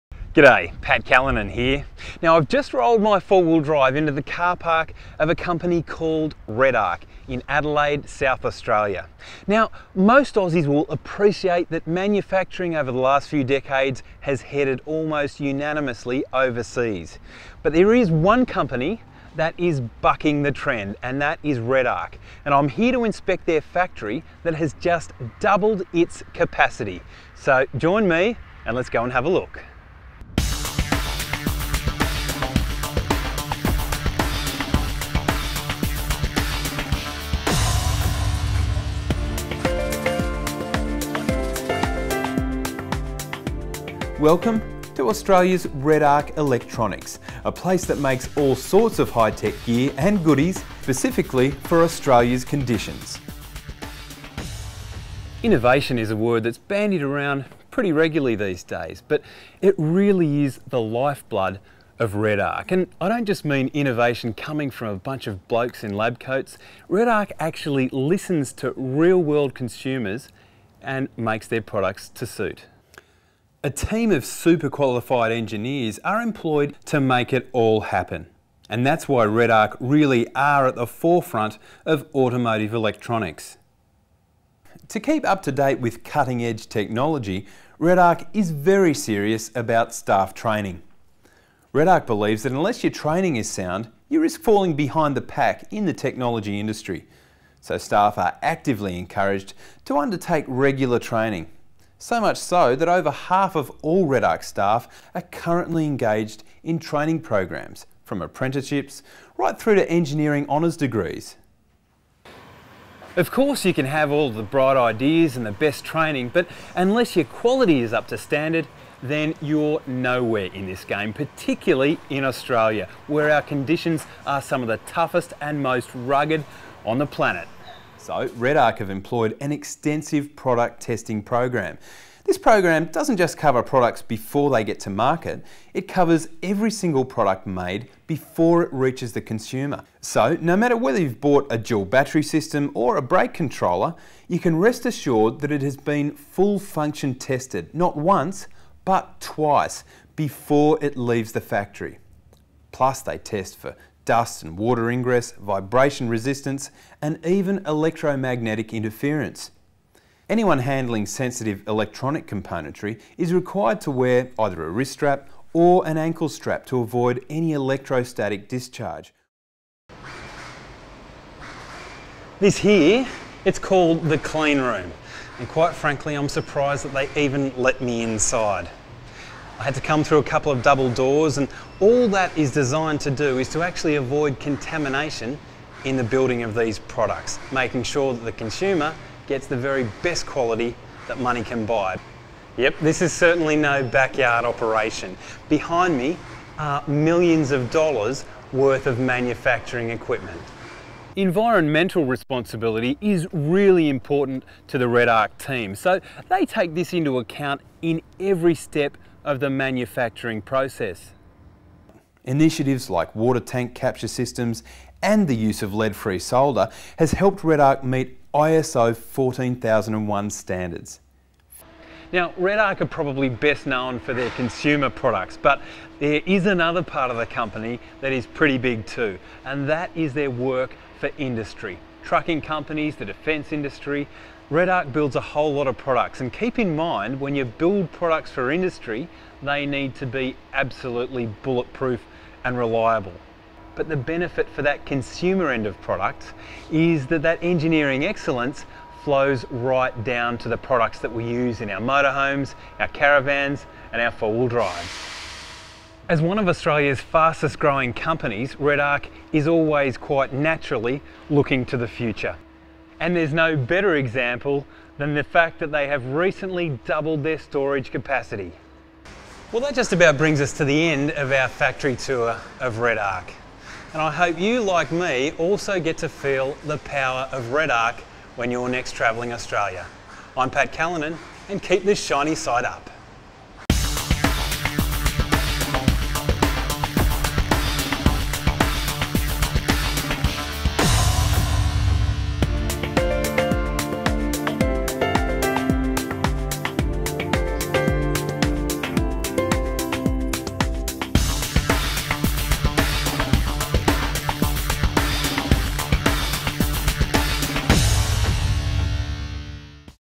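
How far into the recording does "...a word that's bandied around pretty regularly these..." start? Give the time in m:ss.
0:56.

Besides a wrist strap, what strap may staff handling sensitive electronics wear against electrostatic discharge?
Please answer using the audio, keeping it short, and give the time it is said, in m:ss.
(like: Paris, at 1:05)
ankle strap, at 2:45.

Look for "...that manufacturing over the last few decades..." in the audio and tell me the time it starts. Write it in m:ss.
0:11.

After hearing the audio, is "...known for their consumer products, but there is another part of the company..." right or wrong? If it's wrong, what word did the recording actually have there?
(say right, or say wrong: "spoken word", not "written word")
right.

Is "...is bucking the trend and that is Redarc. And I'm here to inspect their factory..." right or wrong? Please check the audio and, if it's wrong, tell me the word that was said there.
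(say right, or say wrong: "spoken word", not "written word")
right.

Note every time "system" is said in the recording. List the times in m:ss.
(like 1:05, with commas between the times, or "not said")
2:22, 3:34.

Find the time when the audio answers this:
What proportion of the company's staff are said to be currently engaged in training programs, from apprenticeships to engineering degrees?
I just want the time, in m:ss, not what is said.
1:42.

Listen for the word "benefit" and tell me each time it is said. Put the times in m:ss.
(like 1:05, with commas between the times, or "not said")
4:03.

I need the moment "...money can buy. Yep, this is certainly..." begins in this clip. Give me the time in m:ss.
3:11.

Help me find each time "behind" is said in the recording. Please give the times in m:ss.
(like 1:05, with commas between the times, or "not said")
1:34, 3:15.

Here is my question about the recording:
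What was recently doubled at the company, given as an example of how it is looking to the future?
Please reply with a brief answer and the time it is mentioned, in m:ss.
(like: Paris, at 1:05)
storage capacity, at 4:27.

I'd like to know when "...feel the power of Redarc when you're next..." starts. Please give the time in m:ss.
4:36.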